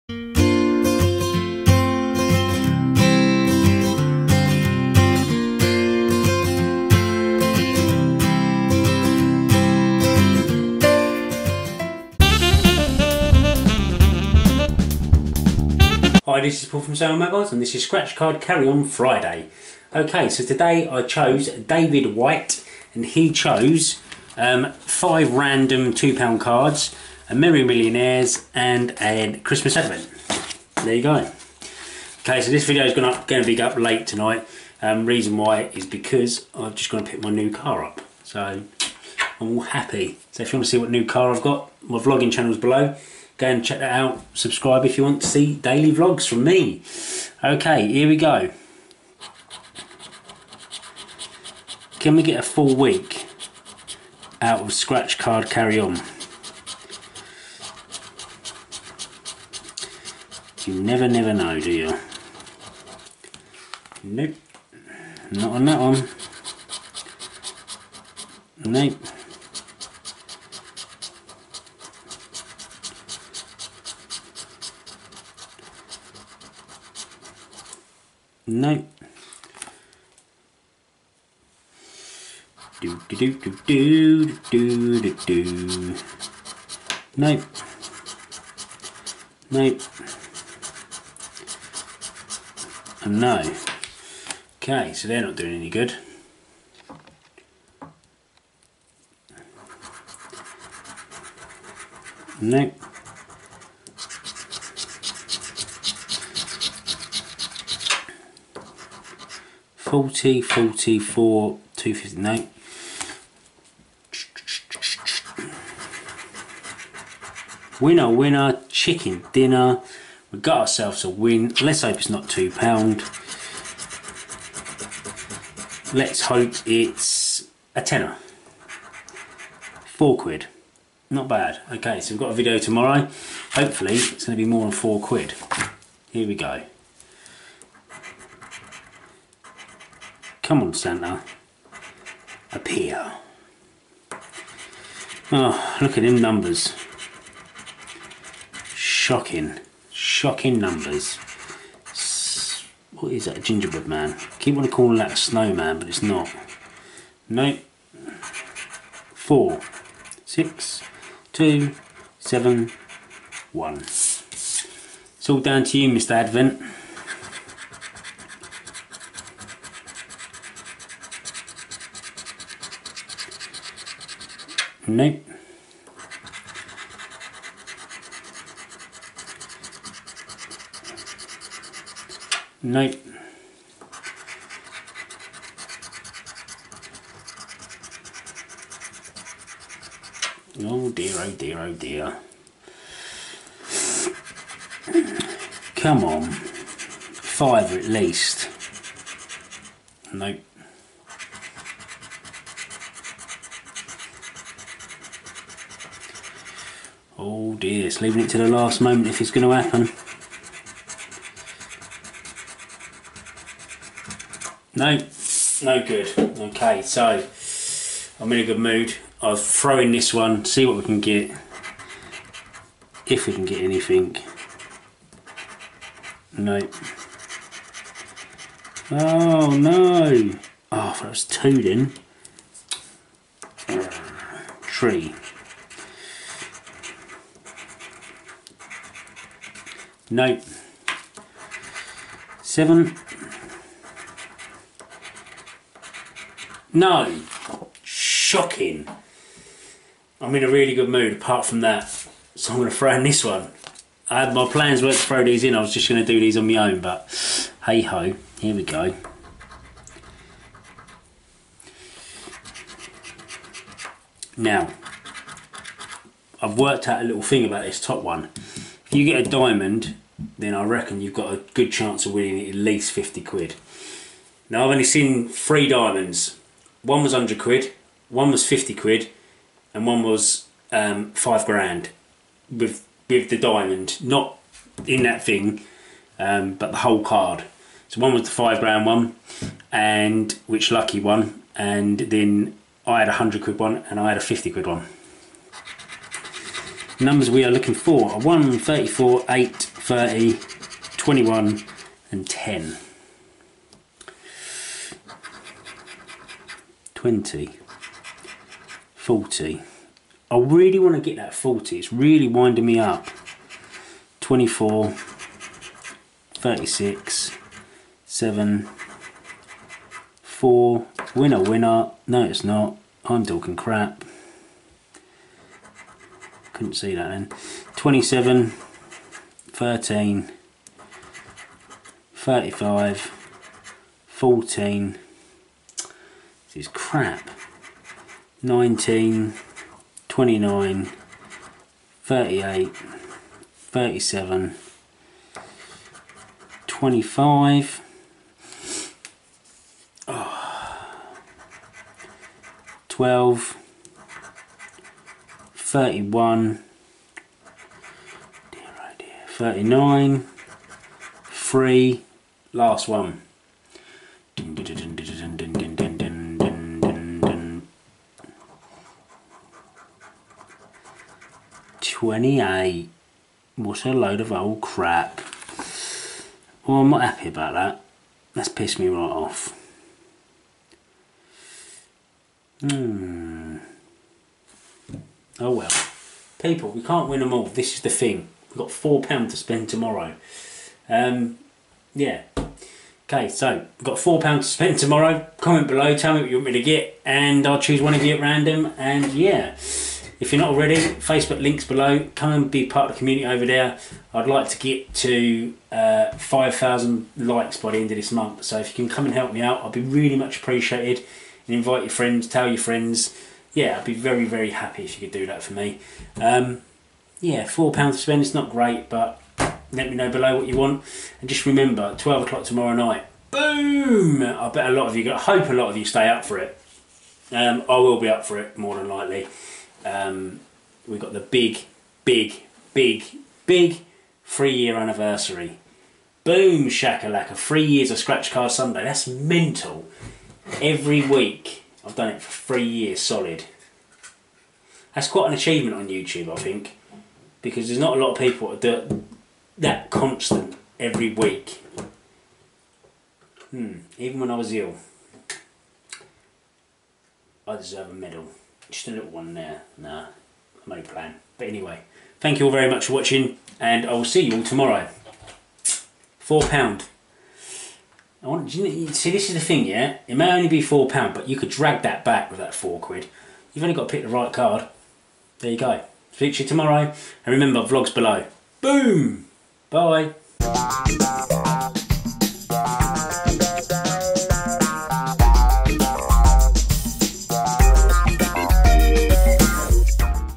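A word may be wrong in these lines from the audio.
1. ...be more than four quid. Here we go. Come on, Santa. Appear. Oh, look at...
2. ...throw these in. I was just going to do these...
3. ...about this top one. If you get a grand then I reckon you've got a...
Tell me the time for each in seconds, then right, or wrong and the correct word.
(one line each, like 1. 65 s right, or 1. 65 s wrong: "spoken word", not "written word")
1. 134 s right
2. 254 s right
3. 267 s wrong: "diamond", not "grand".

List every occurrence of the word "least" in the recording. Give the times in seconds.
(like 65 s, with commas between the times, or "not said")
197 s, 272 s.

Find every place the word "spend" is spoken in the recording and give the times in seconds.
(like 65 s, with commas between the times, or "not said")
389 s, 394 s, 418 s.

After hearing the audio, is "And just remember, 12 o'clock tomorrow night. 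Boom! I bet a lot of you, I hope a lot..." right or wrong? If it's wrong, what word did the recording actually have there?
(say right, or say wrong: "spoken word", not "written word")
right.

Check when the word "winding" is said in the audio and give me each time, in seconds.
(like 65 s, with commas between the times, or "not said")
312 s.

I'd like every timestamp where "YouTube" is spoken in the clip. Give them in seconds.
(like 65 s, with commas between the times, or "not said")
445 s.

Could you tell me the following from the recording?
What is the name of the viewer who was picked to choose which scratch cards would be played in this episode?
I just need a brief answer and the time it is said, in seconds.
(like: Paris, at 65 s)
David White, at 21 s.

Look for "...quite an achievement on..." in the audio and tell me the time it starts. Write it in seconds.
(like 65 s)
445 s.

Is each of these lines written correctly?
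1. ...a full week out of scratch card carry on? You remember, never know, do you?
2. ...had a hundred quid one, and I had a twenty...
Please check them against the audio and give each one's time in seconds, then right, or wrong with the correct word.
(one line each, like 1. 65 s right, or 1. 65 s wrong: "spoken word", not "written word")
1. 52 s wrong: "never", not "remember"
2. 292 s wrong: "fifty", not "twenty".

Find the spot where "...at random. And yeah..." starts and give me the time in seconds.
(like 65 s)
398 s.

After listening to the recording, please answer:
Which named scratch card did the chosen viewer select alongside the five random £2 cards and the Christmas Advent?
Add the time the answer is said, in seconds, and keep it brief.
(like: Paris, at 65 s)
Merry Millionaires, at 27 s.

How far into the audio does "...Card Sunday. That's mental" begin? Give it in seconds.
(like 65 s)
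438 s.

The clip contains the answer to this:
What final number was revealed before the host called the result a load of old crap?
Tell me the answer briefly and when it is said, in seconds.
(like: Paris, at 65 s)
28, at 371 s.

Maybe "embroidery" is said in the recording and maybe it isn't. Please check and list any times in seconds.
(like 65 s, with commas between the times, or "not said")
not said.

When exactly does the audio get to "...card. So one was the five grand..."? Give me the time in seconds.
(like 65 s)
287 s.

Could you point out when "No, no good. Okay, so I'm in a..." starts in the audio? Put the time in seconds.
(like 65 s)
214 s.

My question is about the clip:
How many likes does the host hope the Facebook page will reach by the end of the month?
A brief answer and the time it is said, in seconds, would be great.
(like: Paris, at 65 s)
5,000, at 406 s.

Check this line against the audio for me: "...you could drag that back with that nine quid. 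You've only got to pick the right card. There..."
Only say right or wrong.
wrong.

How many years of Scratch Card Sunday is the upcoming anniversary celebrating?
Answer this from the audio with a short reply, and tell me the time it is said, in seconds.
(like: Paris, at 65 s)
3, at 434 s.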